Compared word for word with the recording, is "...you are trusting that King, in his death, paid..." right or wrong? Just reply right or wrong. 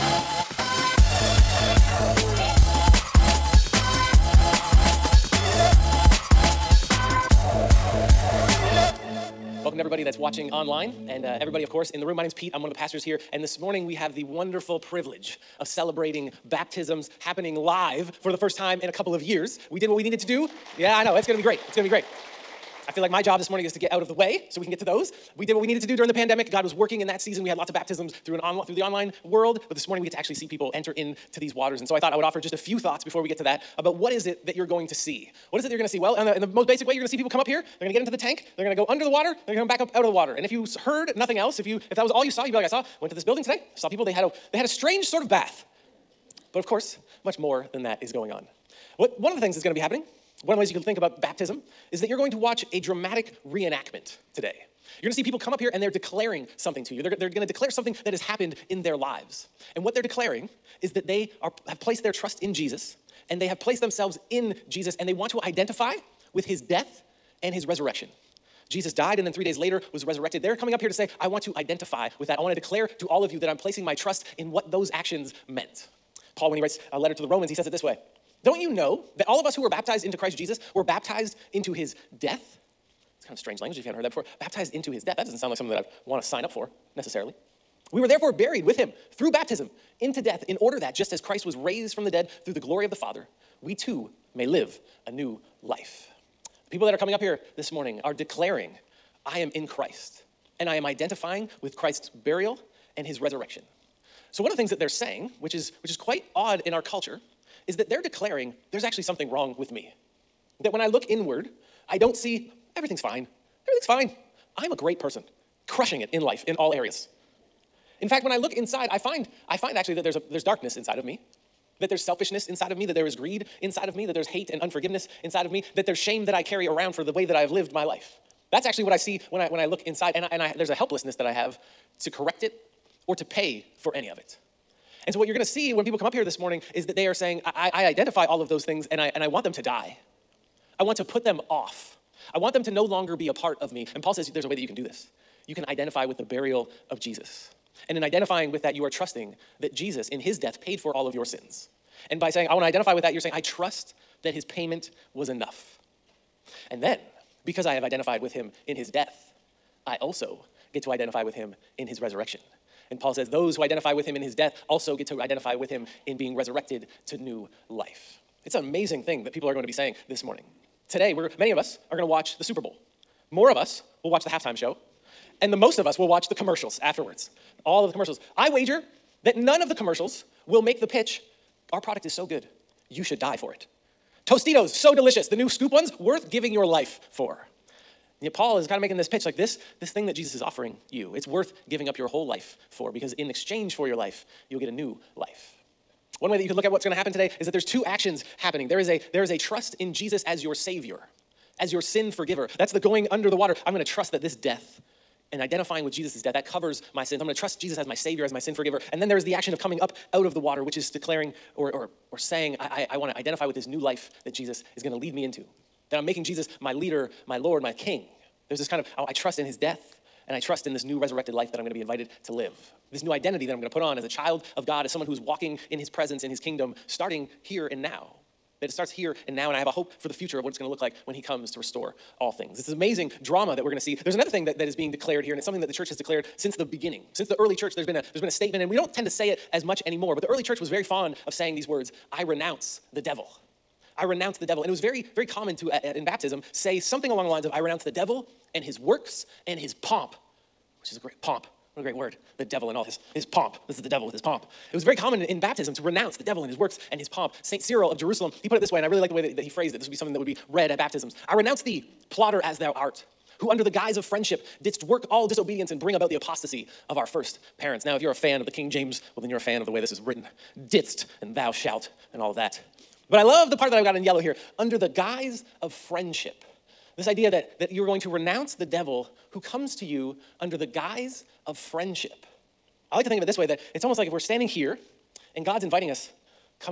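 wrong.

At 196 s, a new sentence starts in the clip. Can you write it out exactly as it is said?
One way that you could look at what's going to happen today is that there's two actions happening.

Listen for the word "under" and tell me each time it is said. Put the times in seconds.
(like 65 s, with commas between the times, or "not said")
38 s, 203 s, 263 s, 274 s, 280 s.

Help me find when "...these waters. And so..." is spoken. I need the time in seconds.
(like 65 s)
31 s.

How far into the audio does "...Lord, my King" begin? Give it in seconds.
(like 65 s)
217 s.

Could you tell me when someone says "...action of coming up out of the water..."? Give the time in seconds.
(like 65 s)
209 s.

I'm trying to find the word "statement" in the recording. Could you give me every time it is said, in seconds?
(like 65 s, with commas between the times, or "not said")
238 s.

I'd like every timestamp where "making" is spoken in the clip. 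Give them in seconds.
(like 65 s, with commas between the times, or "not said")
188 s, 216 s.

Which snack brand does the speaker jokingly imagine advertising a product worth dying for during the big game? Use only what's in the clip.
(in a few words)
Tostitos.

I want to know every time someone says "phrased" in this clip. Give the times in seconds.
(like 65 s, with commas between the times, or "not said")
259 s.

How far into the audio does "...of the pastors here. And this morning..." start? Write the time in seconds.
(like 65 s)
12 s.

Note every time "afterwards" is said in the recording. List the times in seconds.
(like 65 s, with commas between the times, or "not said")
176 s.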